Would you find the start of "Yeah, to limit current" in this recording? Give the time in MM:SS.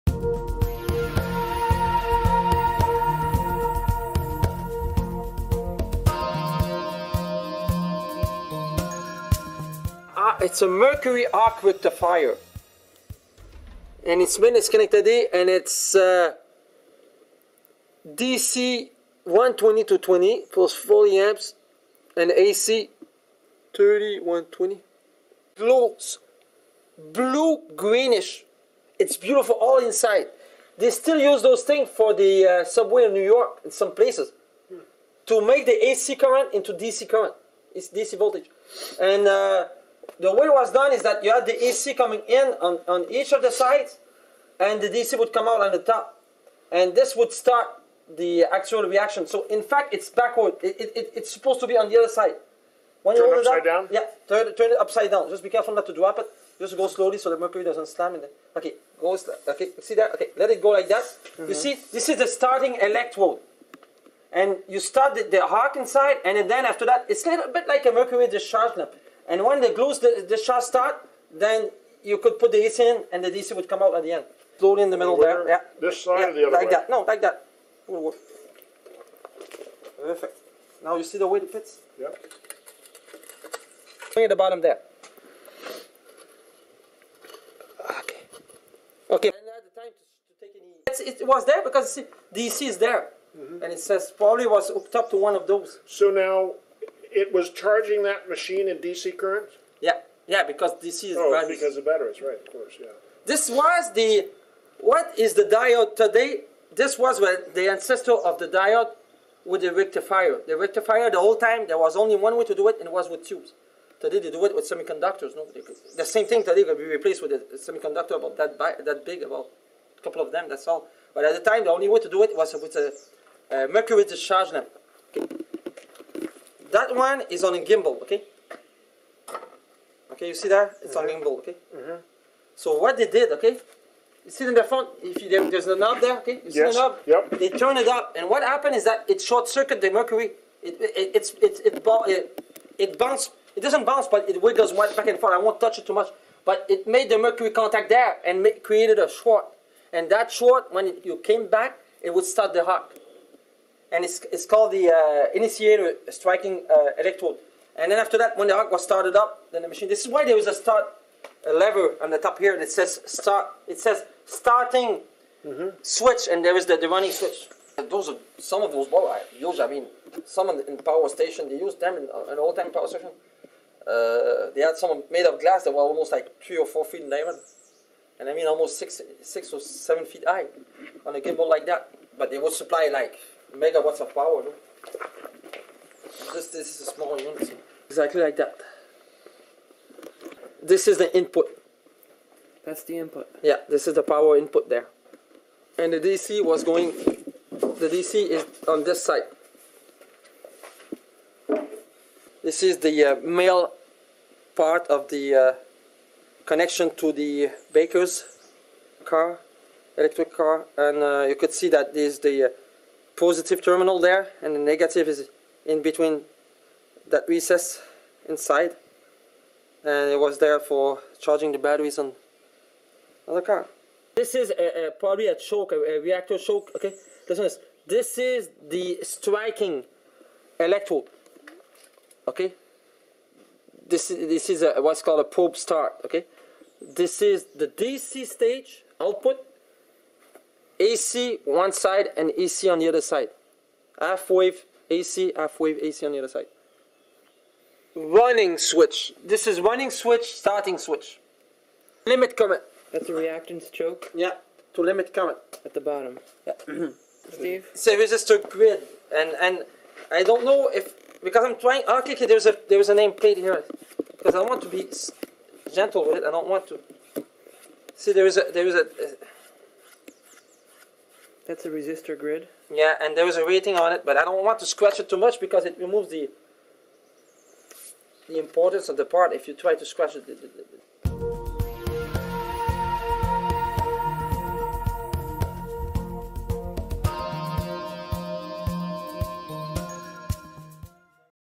04:14.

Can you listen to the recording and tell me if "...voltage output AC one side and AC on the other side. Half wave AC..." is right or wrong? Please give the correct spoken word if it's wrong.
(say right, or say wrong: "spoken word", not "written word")
wrong: "stage", not "voltage".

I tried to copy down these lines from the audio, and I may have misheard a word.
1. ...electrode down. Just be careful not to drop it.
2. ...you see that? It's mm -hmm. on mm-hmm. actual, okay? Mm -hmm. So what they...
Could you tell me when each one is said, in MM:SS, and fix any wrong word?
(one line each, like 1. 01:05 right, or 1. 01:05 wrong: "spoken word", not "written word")
1. 00:54 wrong: "upside", not "electrode"
2. 02:10 wrong: "gimbal", not "actual".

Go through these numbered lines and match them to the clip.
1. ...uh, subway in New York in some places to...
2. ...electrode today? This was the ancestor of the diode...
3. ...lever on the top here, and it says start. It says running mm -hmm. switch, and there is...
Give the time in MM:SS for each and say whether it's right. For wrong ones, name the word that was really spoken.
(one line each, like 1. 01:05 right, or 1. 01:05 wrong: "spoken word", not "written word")
1. 00:32 right
2. 01:45 wrong: "diode", not "electrode"
3. 02:41 wrong: "starting", not "running".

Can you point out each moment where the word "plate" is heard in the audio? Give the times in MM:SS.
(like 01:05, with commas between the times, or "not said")
04:23.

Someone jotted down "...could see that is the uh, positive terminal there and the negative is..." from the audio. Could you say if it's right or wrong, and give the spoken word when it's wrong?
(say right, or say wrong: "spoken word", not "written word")
right.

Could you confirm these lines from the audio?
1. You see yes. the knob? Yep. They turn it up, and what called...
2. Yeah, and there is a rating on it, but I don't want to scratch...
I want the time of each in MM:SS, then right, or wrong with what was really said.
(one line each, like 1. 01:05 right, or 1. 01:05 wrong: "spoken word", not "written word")
1. 02:16 wrong: "happened", not "called"
2. 04:32 right.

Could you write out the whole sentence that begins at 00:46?
And this would start the actual reaction.